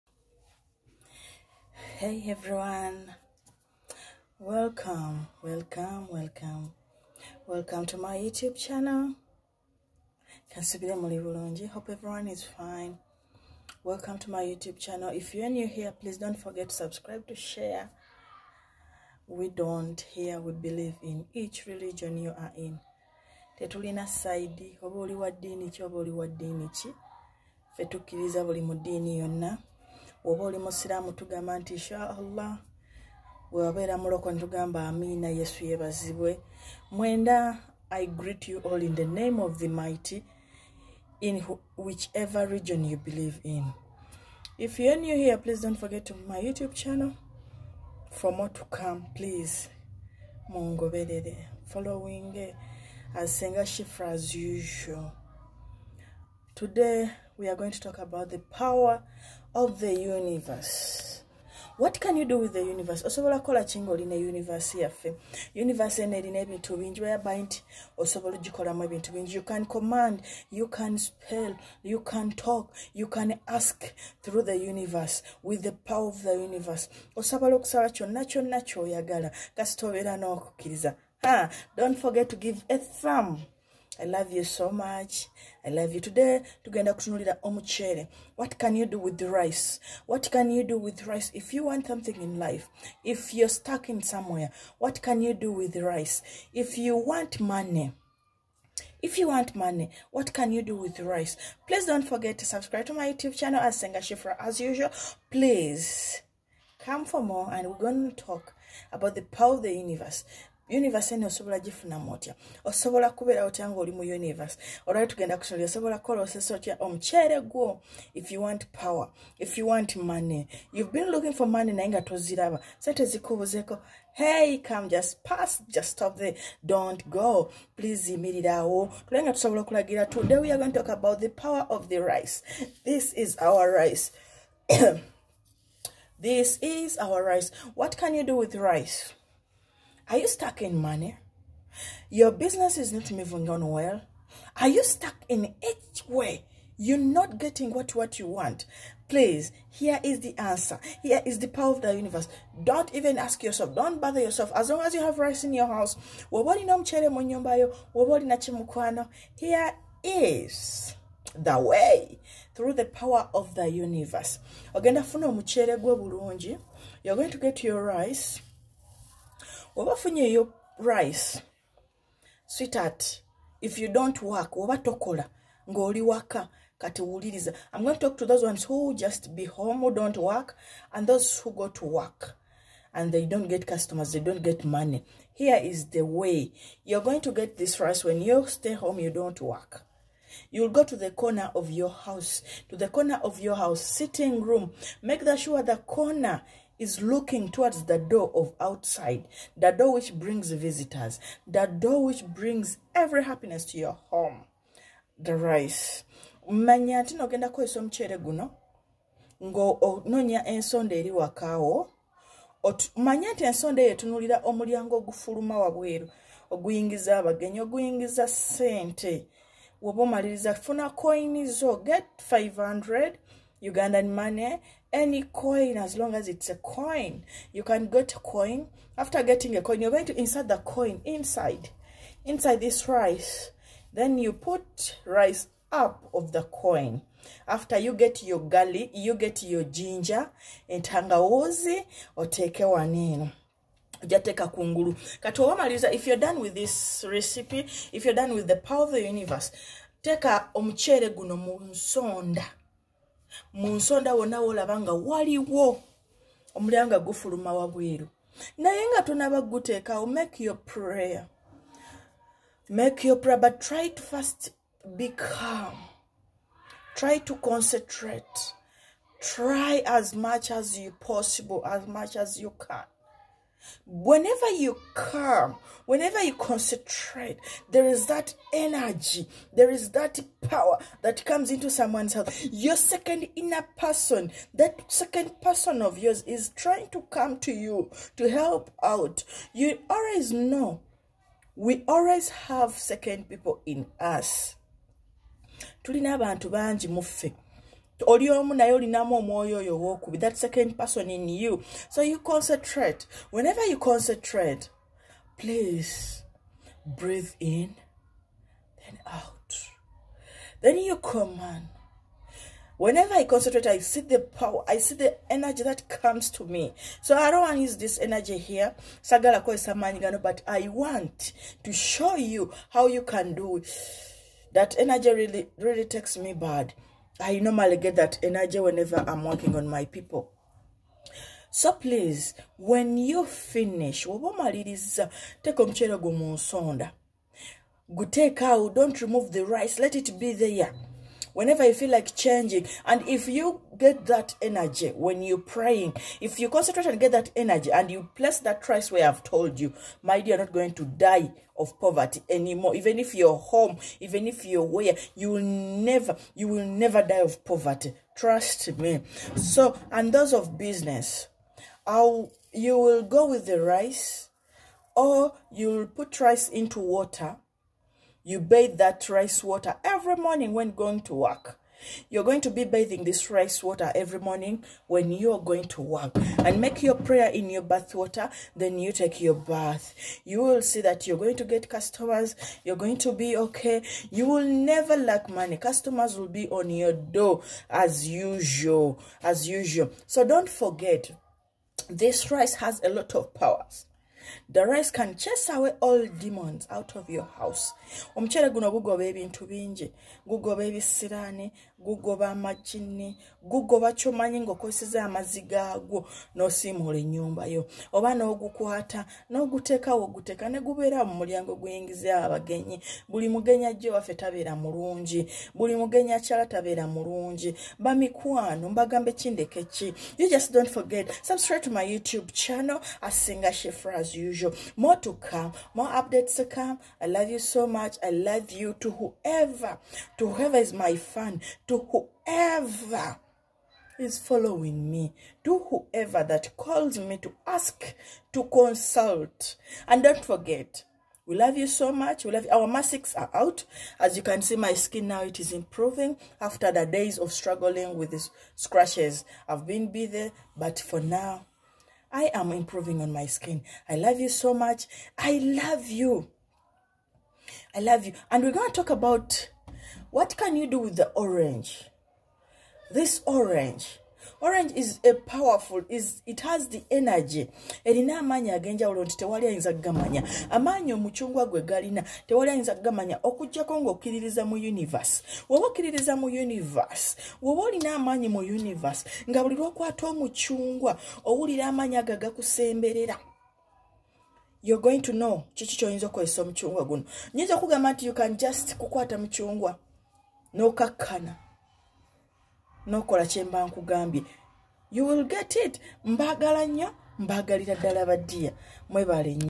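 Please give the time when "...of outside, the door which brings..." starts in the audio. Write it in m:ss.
3:18.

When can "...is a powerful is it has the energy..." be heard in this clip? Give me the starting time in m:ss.
7:44.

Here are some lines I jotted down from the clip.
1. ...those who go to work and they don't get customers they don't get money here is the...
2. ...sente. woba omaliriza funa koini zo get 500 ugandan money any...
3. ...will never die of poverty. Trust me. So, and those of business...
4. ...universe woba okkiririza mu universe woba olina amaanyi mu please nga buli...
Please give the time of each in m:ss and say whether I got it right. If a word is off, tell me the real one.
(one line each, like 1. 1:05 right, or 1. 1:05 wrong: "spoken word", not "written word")
1. 3:01 right
2. 3:38 right
3. 5:56 right
4. 7:54 wrong: "universe", not "please".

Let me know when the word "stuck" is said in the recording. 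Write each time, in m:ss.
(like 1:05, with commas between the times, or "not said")
1:33, 2:20, 2:24.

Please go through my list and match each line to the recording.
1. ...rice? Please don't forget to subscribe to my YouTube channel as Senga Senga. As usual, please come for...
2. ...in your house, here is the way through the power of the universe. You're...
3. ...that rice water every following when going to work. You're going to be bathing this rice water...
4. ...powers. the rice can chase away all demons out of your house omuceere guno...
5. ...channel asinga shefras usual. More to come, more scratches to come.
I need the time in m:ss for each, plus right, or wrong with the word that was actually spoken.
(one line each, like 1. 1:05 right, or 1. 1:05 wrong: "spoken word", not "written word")
1. 1:40 wrong: "Shifra", not "Senga"
2. 2:35 right
3. 6:08 wrong: "morning", not "following"
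4. 6:33 right
5. 7:02 wrong: "updates", not "scratches".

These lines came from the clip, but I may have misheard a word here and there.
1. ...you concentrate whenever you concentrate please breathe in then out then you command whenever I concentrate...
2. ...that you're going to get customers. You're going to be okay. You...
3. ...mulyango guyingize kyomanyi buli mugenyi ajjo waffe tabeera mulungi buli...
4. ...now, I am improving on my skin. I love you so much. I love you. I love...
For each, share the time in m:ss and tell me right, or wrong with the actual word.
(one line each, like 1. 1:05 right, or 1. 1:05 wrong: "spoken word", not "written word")
1. 5:02 right
2. 6:20 right
3. 6:51 wrong: "abagenyi", not "kyomanyi"
4. 7:30 right.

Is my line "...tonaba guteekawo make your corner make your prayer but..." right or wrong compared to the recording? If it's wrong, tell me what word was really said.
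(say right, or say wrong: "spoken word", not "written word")
wrong: "prayer", not "corner".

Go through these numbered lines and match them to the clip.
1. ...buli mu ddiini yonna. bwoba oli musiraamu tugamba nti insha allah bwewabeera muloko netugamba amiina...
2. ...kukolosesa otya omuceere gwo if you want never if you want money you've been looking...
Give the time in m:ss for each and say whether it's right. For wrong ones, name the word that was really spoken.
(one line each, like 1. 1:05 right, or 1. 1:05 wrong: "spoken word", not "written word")
1. 0:28 right
2. 1:55 wrong: "power", not "never".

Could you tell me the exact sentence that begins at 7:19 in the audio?
And don't forget, we love you so much.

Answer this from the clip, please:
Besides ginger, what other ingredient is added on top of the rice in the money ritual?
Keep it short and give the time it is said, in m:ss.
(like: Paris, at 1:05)
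Garlic, at 3:58.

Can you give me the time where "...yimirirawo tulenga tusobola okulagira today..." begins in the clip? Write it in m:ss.
2:08.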